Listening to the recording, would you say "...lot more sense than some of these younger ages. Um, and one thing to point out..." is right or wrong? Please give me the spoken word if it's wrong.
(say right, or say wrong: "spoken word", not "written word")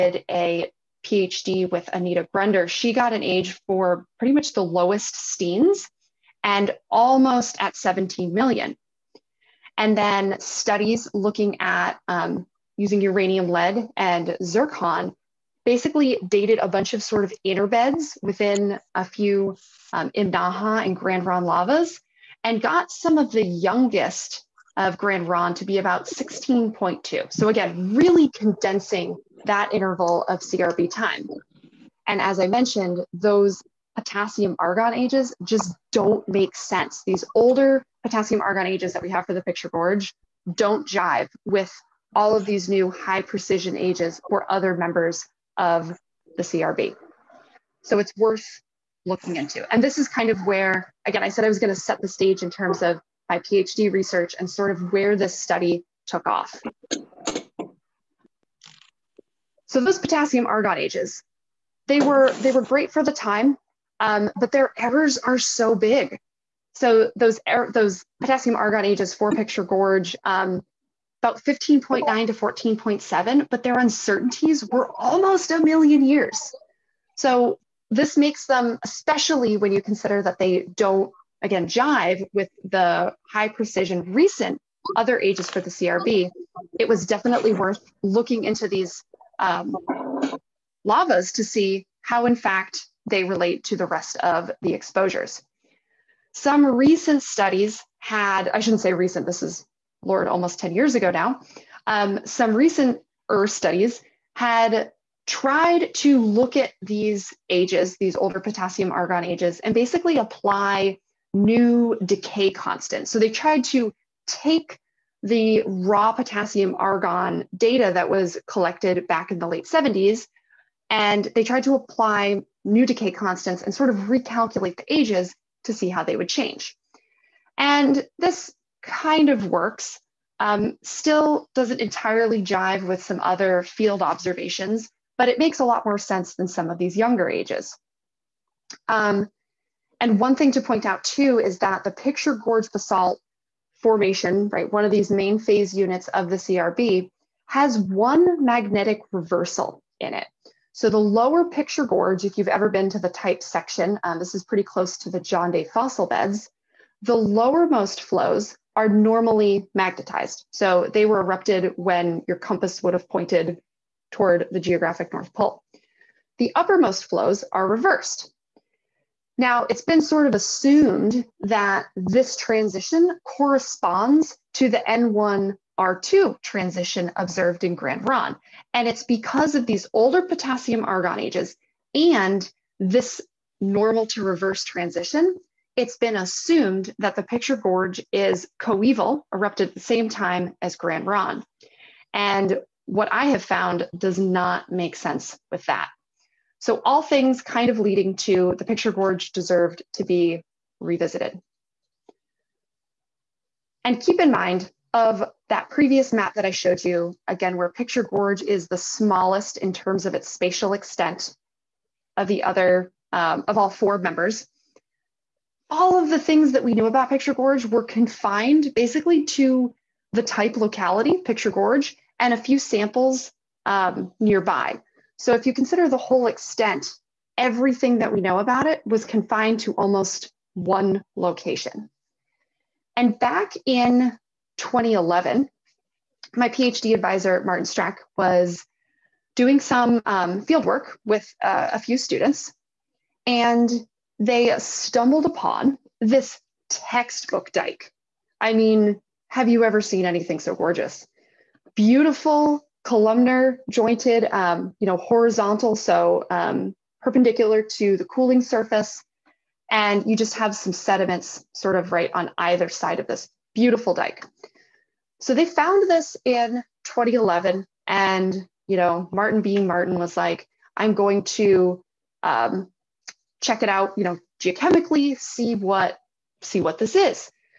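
right.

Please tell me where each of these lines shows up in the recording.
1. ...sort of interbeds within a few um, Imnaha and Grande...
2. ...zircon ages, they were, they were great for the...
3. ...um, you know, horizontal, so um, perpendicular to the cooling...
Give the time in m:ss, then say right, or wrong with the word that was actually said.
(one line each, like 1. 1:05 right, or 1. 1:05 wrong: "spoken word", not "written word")
1. 0:17 right
2. 1:00 wrong: "argon", not "zircon"
3. 4:14 right.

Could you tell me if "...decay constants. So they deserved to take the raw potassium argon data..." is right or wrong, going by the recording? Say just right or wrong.
wrong.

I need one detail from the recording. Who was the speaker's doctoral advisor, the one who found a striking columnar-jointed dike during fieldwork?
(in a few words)
Martin Streck.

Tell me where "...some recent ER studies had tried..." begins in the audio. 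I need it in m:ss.
1:42.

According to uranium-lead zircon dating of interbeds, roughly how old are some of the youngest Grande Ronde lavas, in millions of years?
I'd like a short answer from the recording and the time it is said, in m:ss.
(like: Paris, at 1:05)
16.2, at 0:26.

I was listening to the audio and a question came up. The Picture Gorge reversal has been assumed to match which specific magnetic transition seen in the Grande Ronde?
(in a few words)
N1 R2 transition.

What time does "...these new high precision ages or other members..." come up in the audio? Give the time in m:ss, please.
0:42.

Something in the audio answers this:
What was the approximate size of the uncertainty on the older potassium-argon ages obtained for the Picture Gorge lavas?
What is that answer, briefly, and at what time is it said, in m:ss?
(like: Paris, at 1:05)
almost a million years, at 1:14.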